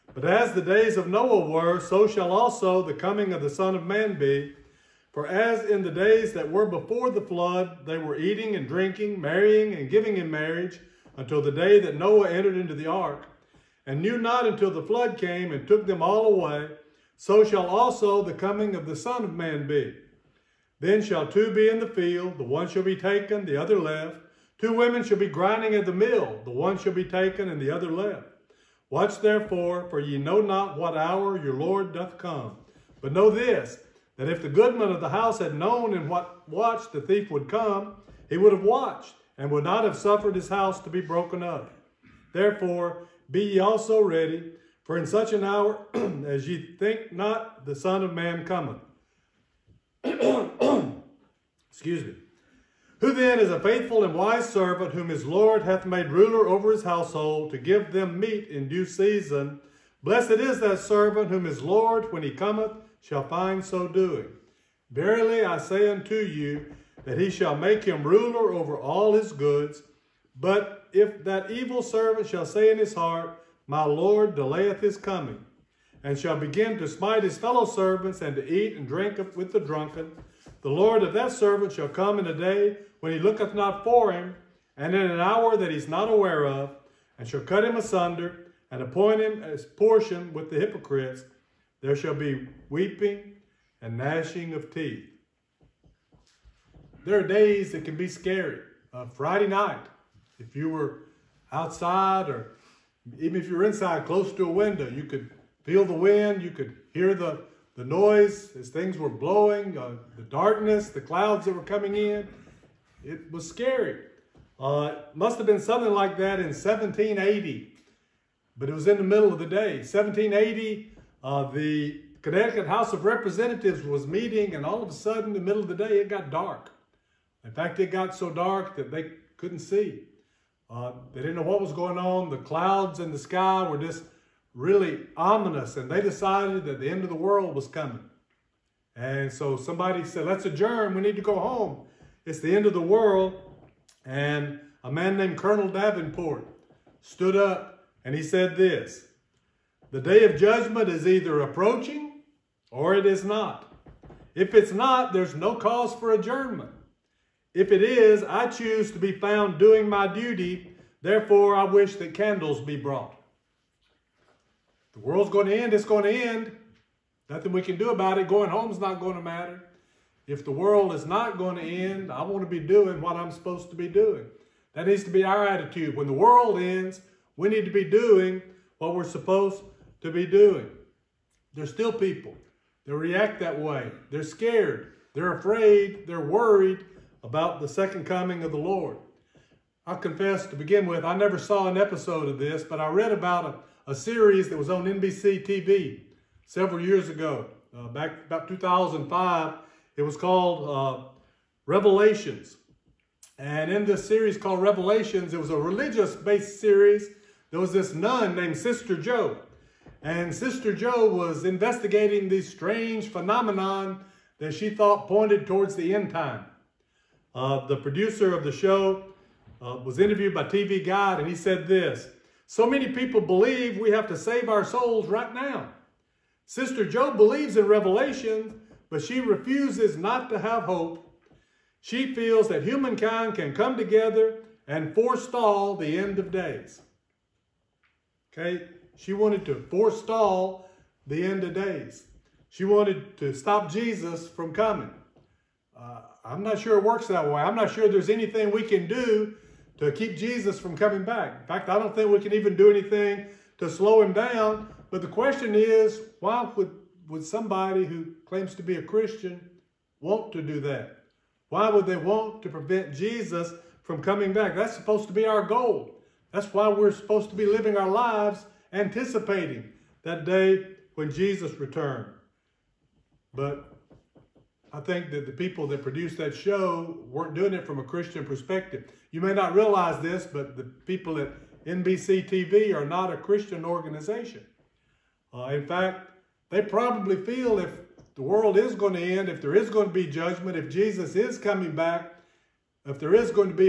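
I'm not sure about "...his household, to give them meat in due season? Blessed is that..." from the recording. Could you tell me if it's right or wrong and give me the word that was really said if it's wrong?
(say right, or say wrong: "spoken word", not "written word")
right.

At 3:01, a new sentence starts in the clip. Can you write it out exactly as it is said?
There's still people that react that way.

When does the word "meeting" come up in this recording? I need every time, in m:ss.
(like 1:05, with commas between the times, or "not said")
2:04.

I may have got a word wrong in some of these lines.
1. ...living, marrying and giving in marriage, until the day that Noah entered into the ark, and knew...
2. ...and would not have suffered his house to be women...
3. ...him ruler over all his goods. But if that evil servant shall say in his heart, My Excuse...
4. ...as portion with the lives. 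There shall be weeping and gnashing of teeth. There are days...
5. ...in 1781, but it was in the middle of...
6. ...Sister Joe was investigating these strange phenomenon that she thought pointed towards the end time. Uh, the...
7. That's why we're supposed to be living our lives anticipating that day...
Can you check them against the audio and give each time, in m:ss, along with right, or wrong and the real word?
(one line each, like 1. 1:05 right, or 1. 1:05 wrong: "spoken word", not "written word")
1. 0:08 wrong: "drinking", not "living"
2. 0:39 wrong: "broken", not "women"
3. 1:07 wrong: "Lord", not "Excuse"
4. 1:29 wrong: "hypocrites", not "lives"
5. 1:56 wrong: "1780", not "1781"
6. 3:30 right
7. 4:26 right.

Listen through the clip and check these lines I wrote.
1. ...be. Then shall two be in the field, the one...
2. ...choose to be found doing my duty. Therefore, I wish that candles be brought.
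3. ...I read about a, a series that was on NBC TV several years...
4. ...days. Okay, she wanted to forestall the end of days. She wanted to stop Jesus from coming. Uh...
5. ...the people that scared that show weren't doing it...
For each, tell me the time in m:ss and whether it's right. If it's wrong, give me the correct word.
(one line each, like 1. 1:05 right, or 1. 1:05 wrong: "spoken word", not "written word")
1. 0:19 right
2. 2:38 right
3. 3:12 right
4. 3:56 right
5. 4:35 wrong: "produced", not "scared".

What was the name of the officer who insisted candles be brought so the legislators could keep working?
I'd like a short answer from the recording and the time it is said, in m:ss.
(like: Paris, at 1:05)
Colonel Davenport, at 2:25.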